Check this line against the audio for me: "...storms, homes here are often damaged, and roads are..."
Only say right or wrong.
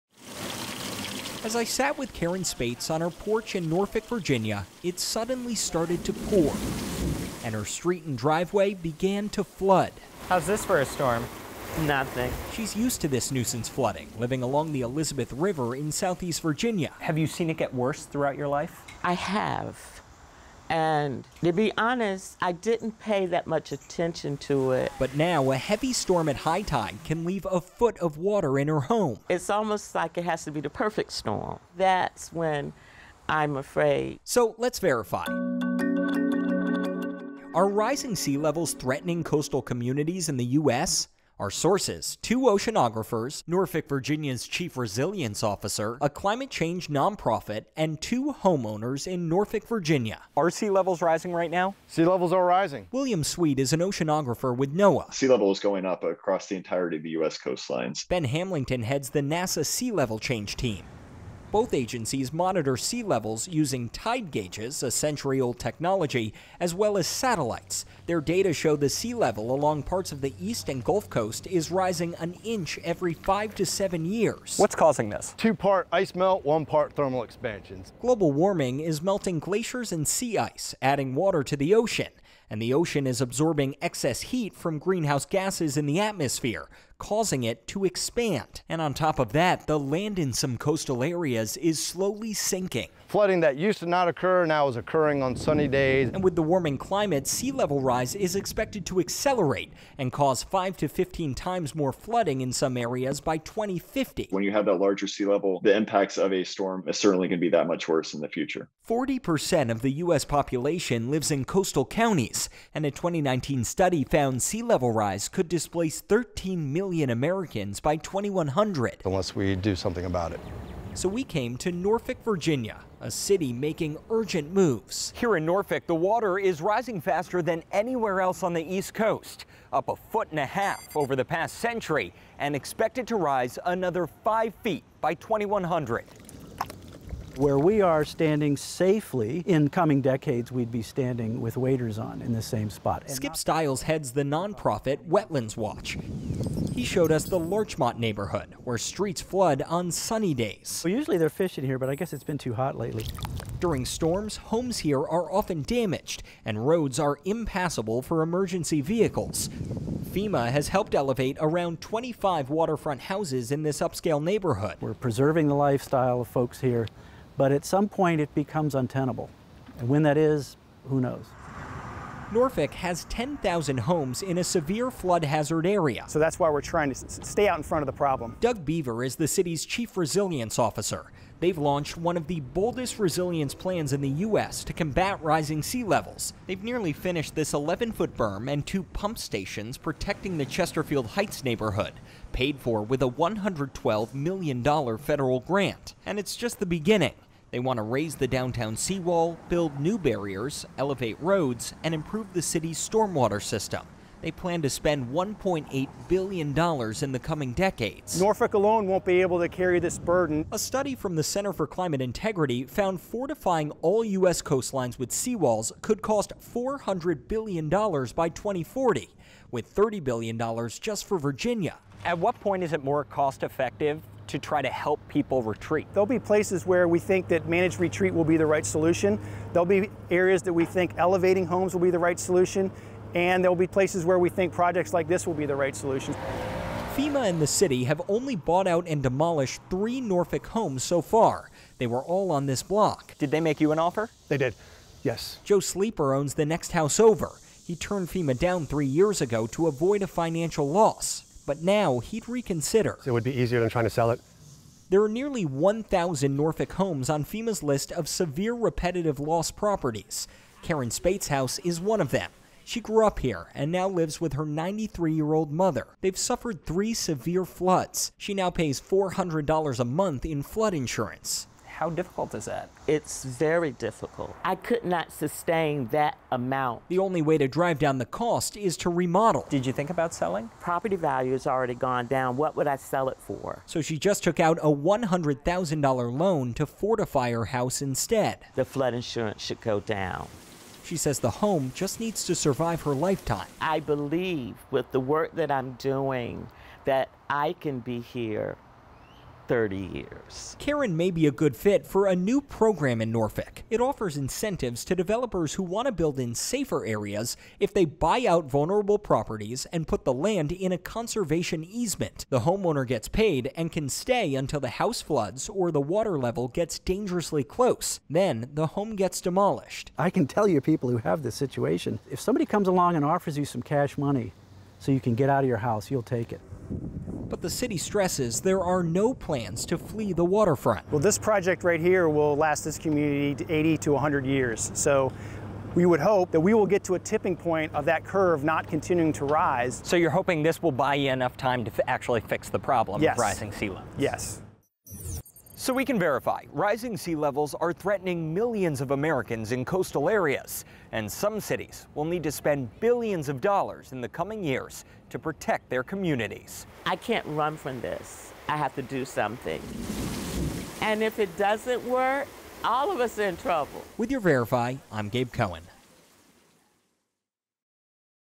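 right.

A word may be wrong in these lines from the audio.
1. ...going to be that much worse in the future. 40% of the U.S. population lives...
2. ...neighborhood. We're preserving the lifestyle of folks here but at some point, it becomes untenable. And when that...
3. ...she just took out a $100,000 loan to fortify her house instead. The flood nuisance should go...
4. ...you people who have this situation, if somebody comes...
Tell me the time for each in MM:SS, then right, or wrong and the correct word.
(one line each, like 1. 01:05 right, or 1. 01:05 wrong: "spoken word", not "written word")
1. 01:47 right
2. 02:44 right
3. 04:43 wrong: "insurance", not "nuisance"
4. 05:20 right.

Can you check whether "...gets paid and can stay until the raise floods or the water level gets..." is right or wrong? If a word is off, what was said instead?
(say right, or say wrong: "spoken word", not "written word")
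wrong: "house", not "raise".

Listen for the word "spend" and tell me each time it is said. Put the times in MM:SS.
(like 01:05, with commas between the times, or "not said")
03:24, 05:52.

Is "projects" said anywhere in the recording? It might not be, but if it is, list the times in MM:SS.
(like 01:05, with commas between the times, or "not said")
03:54, 05:31.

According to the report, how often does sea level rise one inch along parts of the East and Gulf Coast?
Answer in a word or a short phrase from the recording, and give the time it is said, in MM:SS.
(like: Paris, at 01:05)
every 5 to 7 years, at 01:12.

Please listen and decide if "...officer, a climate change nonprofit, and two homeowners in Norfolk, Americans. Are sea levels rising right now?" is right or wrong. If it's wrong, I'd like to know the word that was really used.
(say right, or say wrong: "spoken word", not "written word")
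wrong: "Virginia", not "Americans".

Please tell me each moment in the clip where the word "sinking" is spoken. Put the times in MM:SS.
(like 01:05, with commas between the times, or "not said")
01:32.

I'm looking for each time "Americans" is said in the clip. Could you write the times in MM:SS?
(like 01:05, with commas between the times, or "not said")
01:57, 05:48.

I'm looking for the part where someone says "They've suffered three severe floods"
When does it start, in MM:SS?
04:25.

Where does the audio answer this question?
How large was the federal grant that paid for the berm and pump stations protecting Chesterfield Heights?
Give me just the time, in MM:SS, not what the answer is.
03:13.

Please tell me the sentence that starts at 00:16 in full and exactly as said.
Have you seen it get worse throughout your life?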